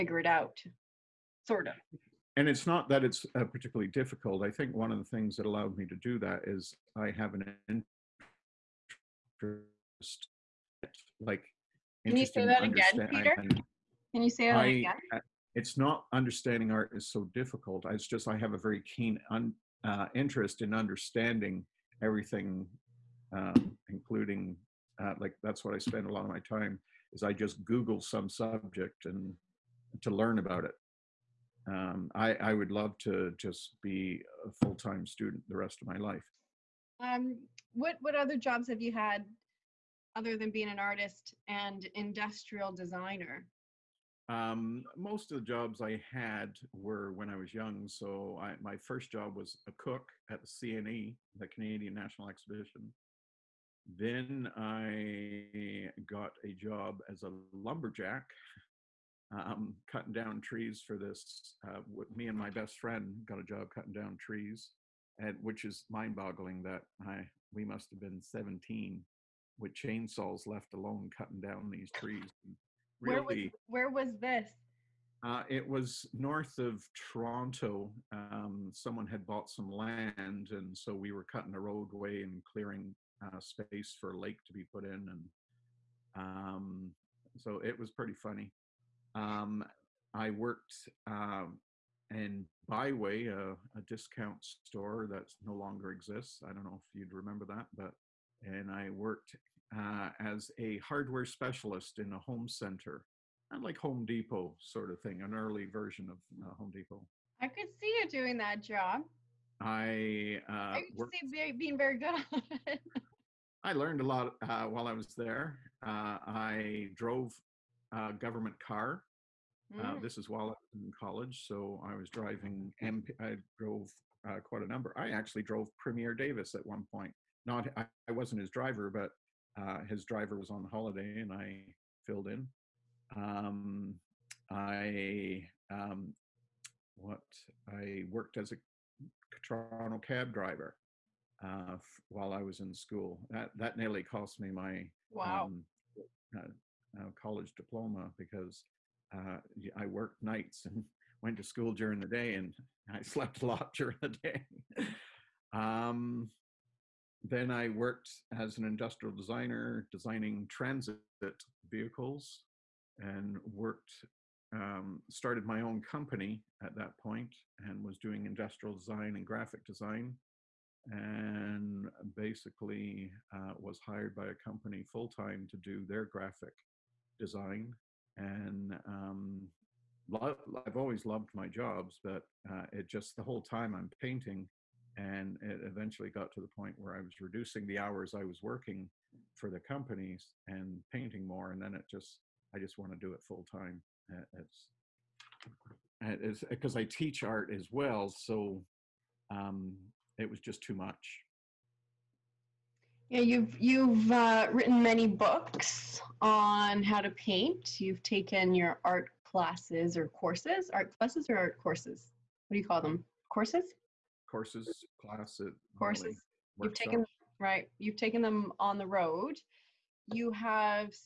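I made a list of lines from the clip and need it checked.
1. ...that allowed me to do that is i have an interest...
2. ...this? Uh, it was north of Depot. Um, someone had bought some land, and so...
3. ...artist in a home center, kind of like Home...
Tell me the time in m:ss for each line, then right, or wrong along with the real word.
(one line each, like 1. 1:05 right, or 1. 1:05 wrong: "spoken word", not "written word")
1. 0:05 right
2. 1:14 wrong: "Toronto", not "Depot"
3. 1:41 wrong: "specialist", not "artist".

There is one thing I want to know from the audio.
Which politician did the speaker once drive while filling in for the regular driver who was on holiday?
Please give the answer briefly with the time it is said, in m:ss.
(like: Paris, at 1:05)
Premier Davis, at 2:05.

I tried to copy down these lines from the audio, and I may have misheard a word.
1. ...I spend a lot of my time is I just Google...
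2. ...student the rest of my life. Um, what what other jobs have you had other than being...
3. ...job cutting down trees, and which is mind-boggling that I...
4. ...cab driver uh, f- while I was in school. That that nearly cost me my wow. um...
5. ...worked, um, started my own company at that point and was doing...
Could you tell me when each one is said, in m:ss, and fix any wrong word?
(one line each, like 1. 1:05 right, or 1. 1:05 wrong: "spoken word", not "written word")
1. 0:25 right
2. 0:35 right
3. 1:03 right
4. 2:20 right
5. 2:43 right.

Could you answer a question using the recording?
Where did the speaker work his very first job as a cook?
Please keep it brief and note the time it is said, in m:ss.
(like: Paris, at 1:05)
Canadian National Exhibition, at 0:51.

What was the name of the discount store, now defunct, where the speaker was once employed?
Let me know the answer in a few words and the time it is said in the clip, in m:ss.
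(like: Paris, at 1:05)
BiWay, at 1:32.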